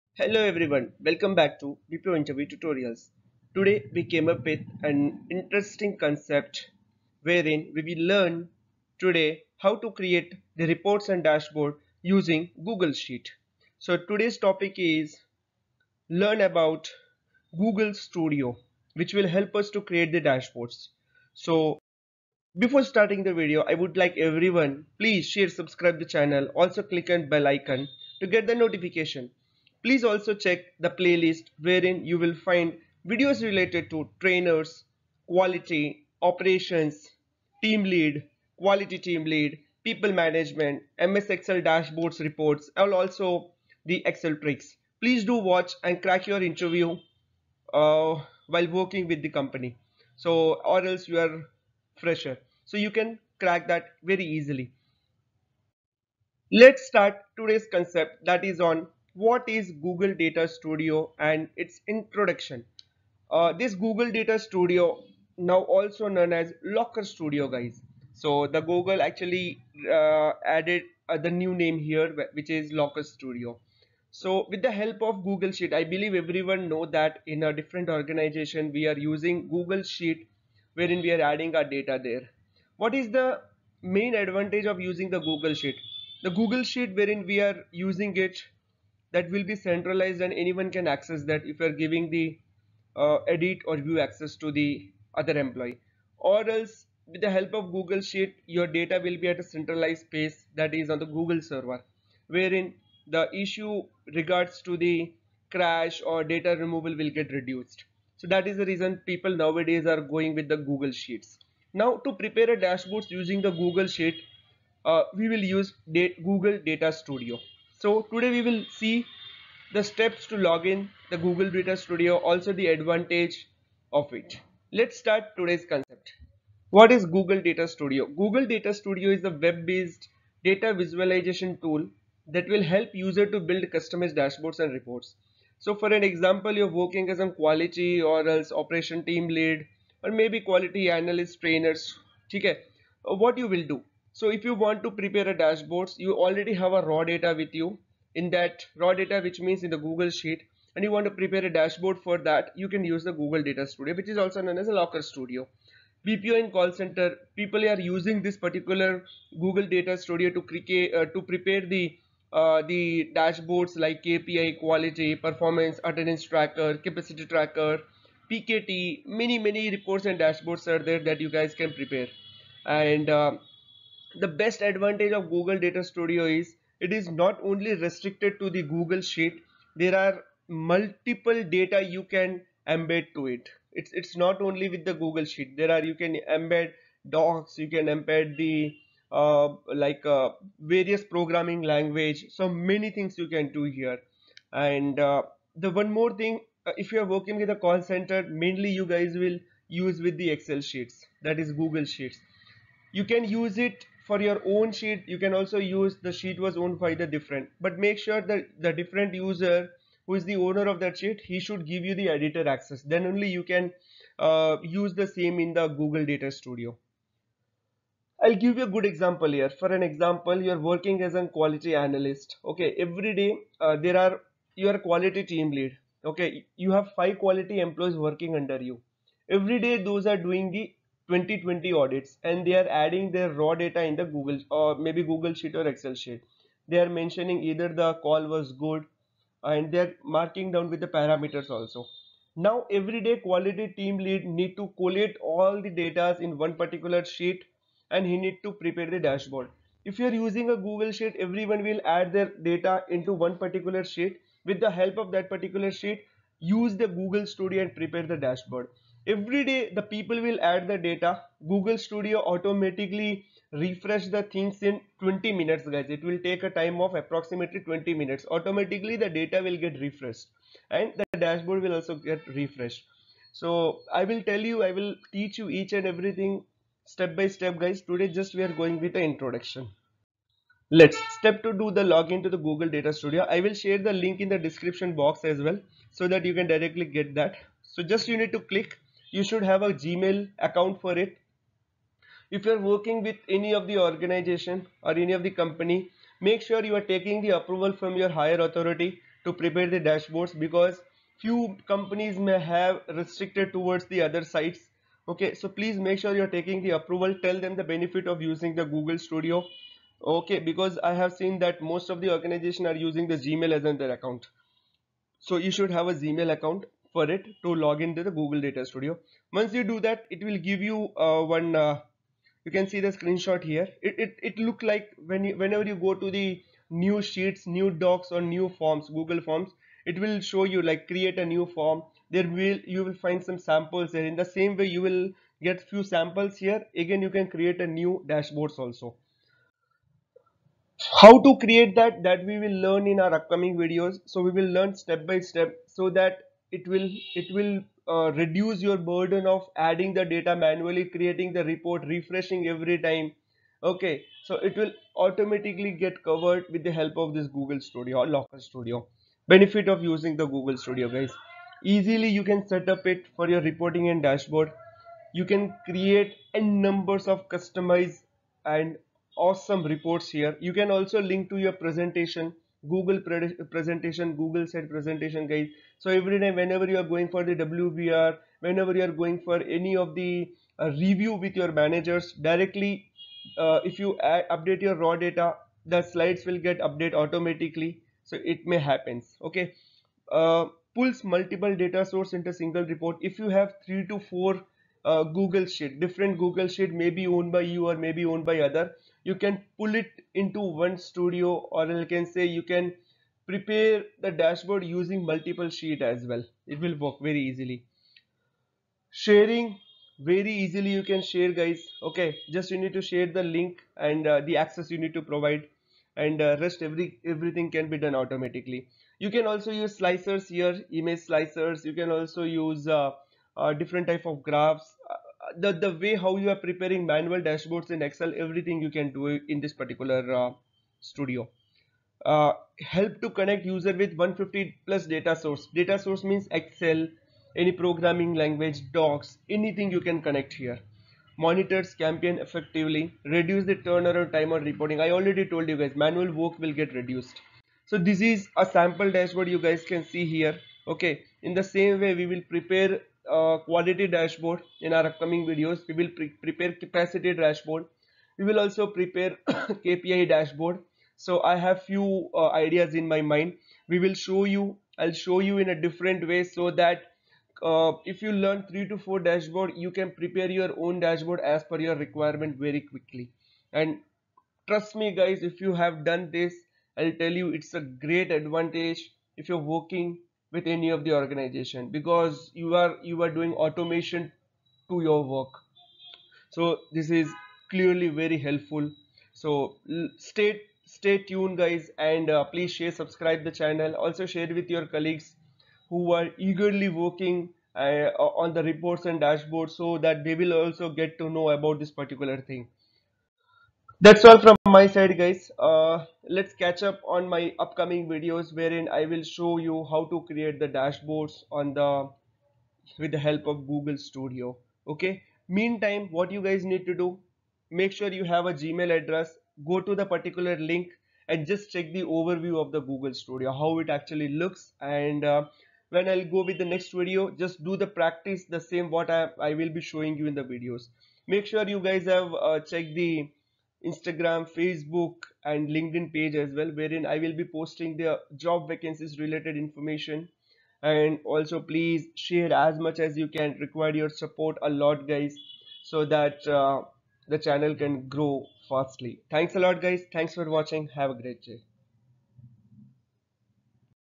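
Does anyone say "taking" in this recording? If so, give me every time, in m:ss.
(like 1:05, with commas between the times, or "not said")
4:56, 5:06.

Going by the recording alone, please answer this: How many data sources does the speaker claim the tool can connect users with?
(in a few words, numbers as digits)
150 plus.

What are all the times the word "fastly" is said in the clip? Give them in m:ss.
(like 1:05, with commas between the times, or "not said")
9:08.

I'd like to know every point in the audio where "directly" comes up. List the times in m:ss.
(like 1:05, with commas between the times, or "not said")
4:46, 6:22.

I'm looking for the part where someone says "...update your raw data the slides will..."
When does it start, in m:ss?
6:24.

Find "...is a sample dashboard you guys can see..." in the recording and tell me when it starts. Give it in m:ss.
7:28.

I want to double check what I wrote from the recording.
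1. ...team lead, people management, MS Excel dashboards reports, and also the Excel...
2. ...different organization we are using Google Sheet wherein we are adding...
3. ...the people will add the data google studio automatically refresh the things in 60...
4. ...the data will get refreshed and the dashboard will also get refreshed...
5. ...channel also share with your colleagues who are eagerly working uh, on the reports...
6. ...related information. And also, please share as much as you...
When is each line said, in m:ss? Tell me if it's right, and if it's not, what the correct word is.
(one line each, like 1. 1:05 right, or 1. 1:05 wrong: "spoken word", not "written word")
1. 0:38 right
2. 1:17 right
3. 4:19 wrong: "20", not "60"
4. 4:29 right
5. 8:13 right
6. 8:58 right.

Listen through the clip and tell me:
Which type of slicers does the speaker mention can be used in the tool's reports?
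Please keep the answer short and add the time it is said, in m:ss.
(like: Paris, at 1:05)
image slicers, at 7:00.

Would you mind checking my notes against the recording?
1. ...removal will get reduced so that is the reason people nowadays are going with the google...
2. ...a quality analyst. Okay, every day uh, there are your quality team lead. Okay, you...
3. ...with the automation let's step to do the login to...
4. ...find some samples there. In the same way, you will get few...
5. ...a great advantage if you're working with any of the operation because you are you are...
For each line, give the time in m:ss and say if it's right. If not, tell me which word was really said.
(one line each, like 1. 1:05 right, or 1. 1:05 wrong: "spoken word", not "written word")
1. 1:46 right
2. 3:41 right
3. 4:38 wrong: "introduction", not "automation"
4. 5:33 right
5. 7:57 wrong: "organization", not "operation".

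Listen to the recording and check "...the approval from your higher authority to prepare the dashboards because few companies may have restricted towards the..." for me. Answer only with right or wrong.
right.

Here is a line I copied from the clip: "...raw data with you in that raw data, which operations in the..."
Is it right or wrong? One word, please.
wrong.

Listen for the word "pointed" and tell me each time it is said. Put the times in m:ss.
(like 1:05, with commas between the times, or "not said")
not said.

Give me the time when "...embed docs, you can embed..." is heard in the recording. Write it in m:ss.
3:06.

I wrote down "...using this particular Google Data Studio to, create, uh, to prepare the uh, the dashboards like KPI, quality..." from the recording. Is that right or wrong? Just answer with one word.
right.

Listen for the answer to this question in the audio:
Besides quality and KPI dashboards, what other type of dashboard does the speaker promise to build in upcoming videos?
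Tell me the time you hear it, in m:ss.
7:36.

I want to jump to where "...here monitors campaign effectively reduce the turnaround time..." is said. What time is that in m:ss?
7:20.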